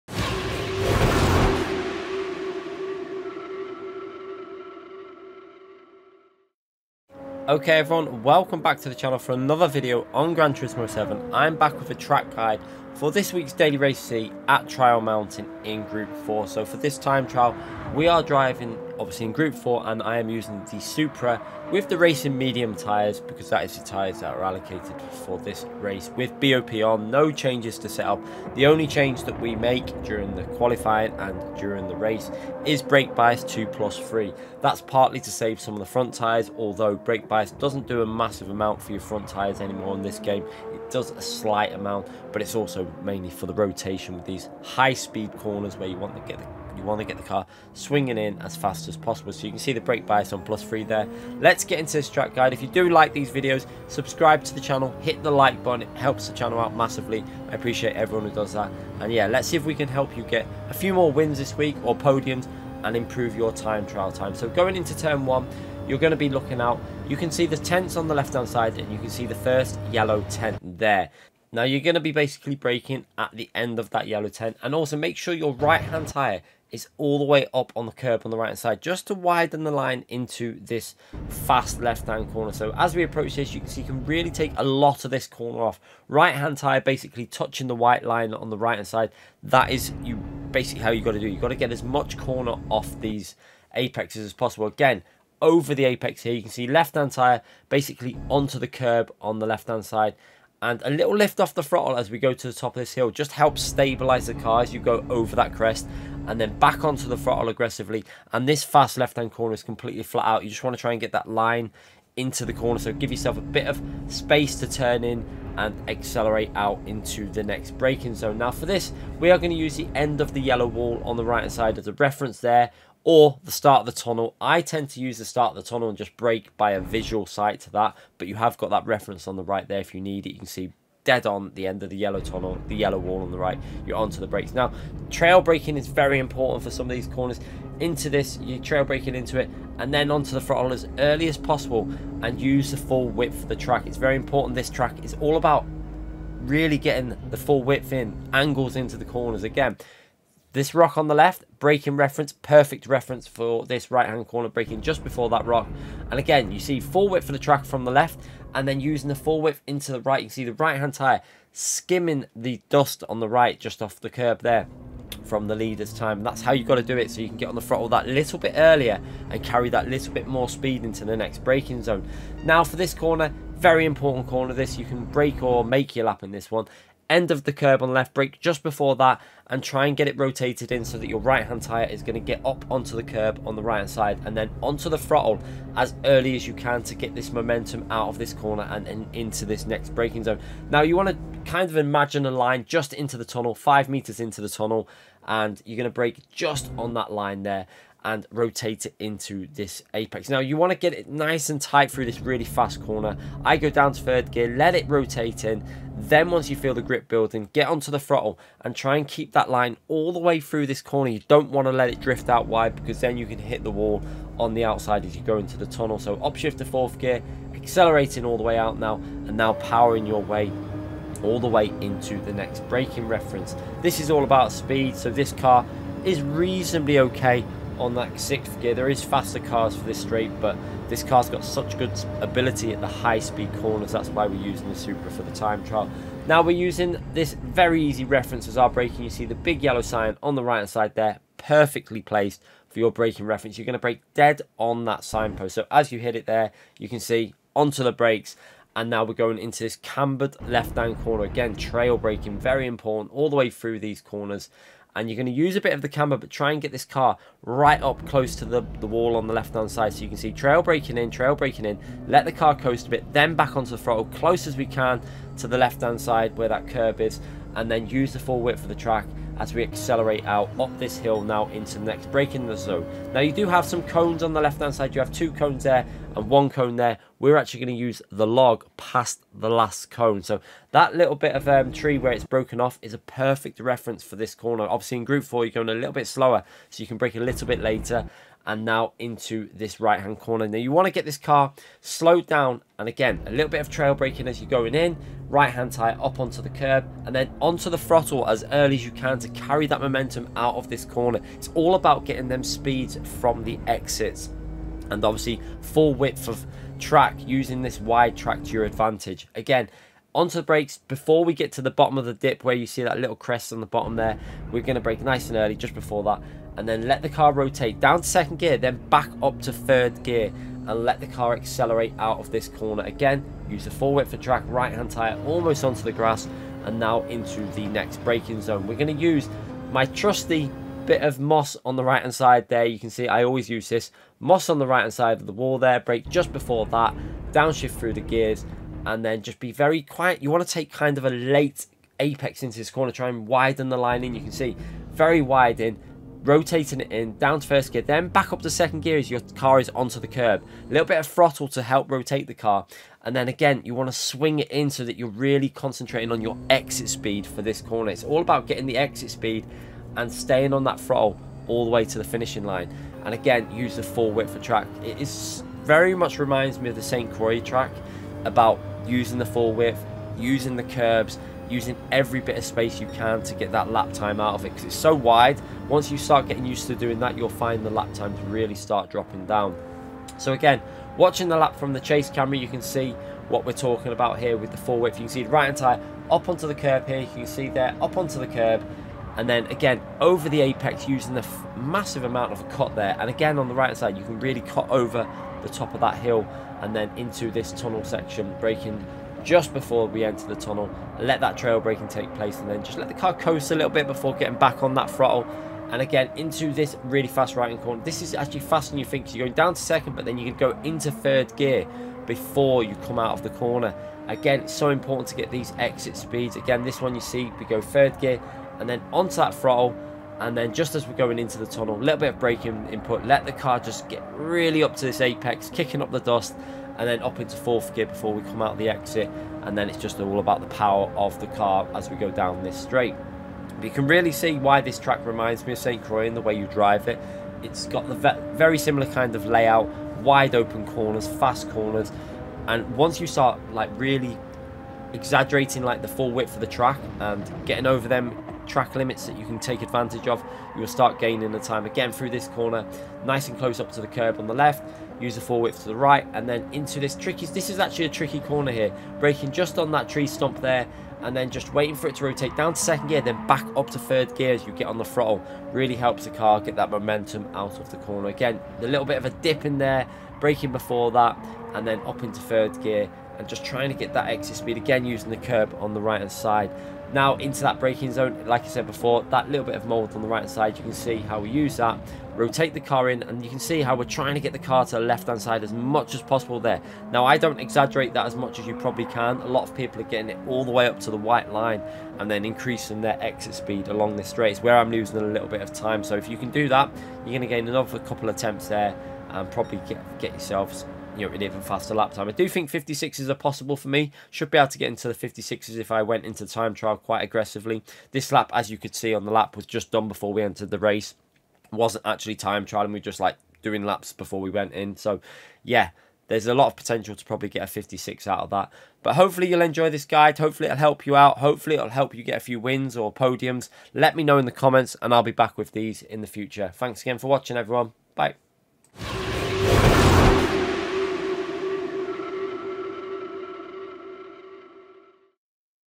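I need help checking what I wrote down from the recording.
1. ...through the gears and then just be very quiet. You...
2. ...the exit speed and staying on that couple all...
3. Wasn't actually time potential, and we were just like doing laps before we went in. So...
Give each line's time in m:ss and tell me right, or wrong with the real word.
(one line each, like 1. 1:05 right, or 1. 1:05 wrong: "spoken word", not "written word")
1. 5:37 right
2. 5:58 wrong: "throttle", not "couple"
3. 8:31 wrong: "trial", not "potential".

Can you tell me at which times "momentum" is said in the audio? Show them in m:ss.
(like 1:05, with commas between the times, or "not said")
3:07, 4:59, 7:46.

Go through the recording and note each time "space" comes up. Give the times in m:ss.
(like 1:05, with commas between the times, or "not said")
1:54, 6:12.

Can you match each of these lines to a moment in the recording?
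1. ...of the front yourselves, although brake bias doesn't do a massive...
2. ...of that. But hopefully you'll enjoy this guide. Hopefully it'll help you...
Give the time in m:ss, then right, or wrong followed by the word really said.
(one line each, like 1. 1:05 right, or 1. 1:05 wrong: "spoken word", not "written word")
1. 0:35 wrong: "tyres", not "yourselves"
2. 8:38 right.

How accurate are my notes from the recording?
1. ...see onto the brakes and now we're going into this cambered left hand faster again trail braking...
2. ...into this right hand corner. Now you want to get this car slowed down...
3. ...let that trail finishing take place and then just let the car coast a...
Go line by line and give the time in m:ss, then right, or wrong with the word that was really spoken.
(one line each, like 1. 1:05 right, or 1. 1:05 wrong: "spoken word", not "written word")
1. 4:06 wrong: "corner", not "faster"
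2. 4:48 right
3. 6:40 wrong: "braking", not "finishing".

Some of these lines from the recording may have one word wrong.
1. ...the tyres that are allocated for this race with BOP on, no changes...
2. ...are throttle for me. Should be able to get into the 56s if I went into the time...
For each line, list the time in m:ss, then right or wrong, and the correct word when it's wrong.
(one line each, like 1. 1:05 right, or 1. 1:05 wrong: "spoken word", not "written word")
1. 0:23 right
2. 8:23 wrong: "possible", not "throttle".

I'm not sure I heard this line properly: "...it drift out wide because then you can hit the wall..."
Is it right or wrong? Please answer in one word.
right.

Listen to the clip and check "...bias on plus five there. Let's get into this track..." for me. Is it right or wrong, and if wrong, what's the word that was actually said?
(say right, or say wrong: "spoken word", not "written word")
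wrong: "three", not "five".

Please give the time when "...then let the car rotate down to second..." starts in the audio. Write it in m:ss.
5:16.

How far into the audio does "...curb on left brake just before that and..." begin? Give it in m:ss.
2:57.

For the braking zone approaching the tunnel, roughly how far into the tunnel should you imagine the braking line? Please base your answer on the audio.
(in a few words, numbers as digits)
5 meters.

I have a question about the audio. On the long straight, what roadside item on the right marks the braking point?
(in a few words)
Big yellow sign.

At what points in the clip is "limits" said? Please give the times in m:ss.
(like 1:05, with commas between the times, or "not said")
7:28.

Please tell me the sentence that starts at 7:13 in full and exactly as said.
But you can really see why this track reminds me of St.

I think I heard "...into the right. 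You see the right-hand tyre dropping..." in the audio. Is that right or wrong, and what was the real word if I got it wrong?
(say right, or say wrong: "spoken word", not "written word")
wrong: "skimming", not "dropping".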